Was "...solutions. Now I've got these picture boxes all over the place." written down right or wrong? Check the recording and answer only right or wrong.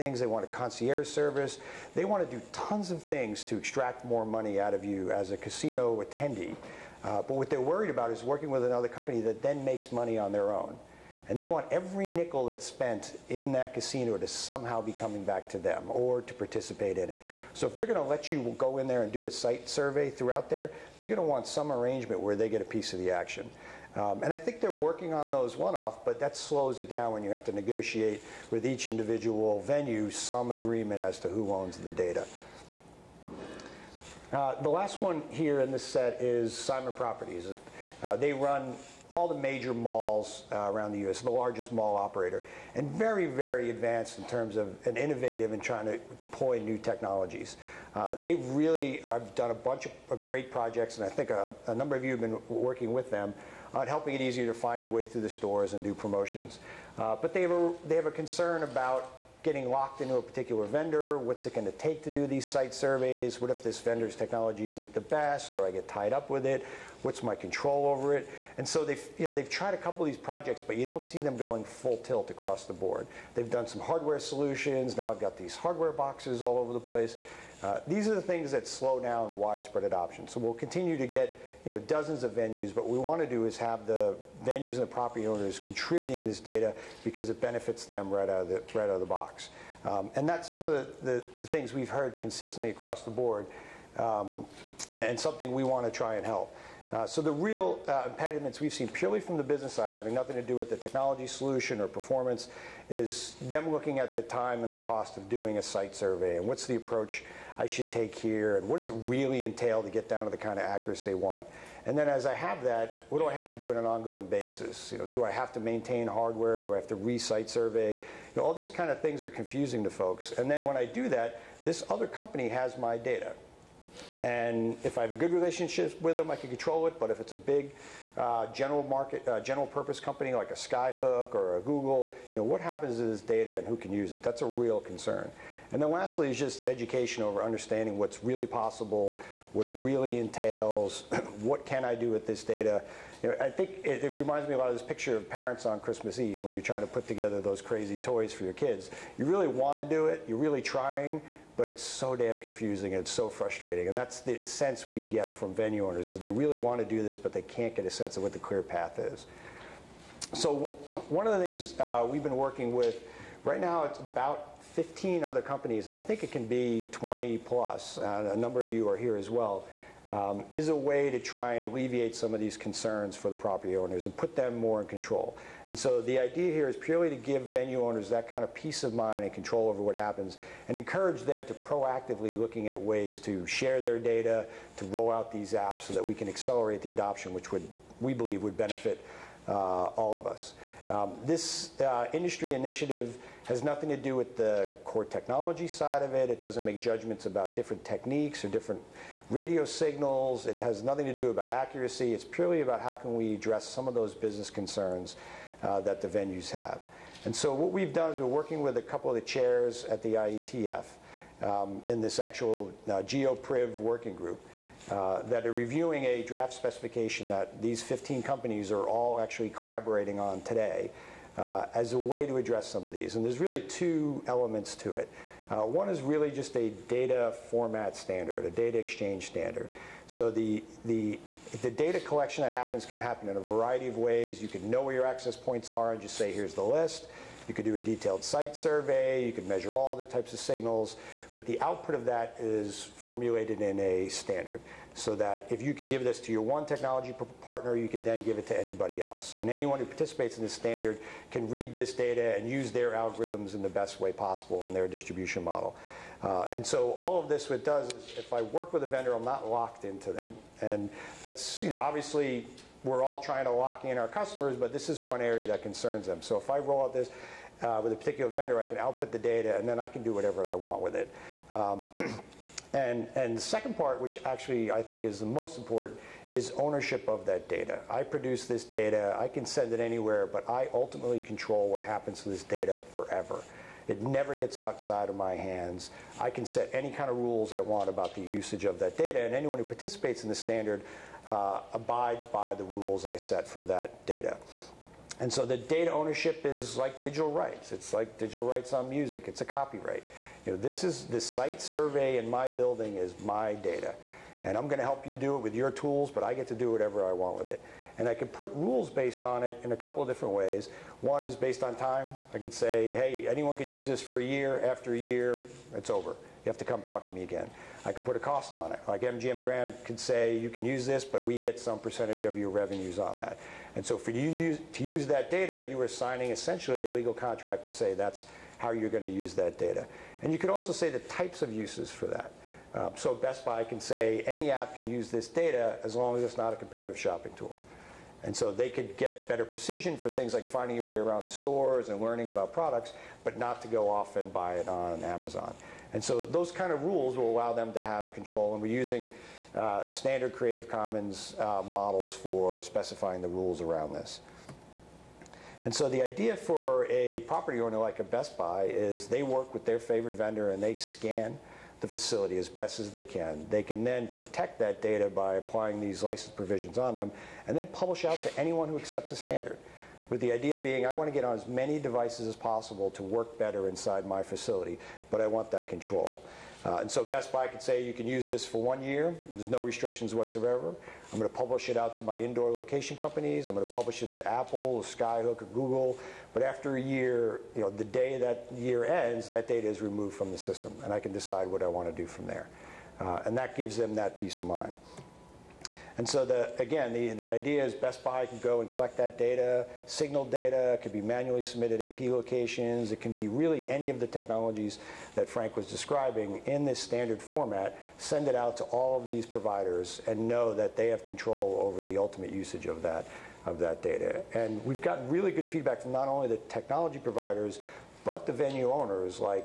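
wrong.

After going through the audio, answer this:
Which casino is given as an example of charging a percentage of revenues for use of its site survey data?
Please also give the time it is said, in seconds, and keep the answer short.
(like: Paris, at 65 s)
MGM Grand, at 319 s.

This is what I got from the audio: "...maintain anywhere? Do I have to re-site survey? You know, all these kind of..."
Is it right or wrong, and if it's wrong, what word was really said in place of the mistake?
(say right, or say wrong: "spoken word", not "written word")
wrong: "hardware", not "anywhere".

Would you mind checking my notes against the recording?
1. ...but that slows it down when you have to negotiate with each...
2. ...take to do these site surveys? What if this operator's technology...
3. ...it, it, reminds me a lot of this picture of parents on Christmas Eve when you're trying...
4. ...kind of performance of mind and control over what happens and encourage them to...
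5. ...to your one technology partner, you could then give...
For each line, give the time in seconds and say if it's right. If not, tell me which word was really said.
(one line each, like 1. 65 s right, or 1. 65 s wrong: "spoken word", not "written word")
1. 26 s right
2. 61 s wrong: "vendor", not "operator"
3. 143 s right
4. 178 s wrong: "peace", not "performance"
5. 246 s right.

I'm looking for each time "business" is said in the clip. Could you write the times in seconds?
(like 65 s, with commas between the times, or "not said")
99 s, 204 s.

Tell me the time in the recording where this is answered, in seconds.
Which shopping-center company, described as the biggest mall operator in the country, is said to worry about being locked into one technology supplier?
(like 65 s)
36 s.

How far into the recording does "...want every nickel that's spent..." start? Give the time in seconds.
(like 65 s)
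11 s.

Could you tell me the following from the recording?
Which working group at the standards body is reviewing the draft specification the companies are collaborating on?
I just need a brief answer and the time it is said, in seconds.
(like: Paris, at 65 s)
GeoPriv, at 213 s.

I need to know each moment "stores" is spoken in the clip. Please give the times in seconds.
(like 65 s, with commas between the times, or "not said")
55 s, 341 s.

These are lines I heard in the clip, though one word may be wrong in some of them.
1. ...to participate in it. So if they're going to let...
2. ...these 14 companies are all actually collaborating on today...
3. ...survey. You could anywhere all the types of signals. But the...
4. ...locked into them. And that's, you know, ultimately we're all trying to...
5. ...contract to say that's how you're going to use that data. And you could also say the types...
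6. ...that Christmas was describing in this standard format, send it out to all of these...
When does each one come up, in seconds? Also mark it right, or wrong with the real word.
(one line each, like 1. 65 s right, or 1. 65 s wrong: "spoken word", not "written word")
1. 16 s right
2. 217 s wrong: "15", not "14"
3. 238 s wrong: "measure", not "anywhere"
4. 259 s wrong: "obviously", not "ultimately"
5. 327 s right
6. 405 s wrong: "Frank", not "Christmas".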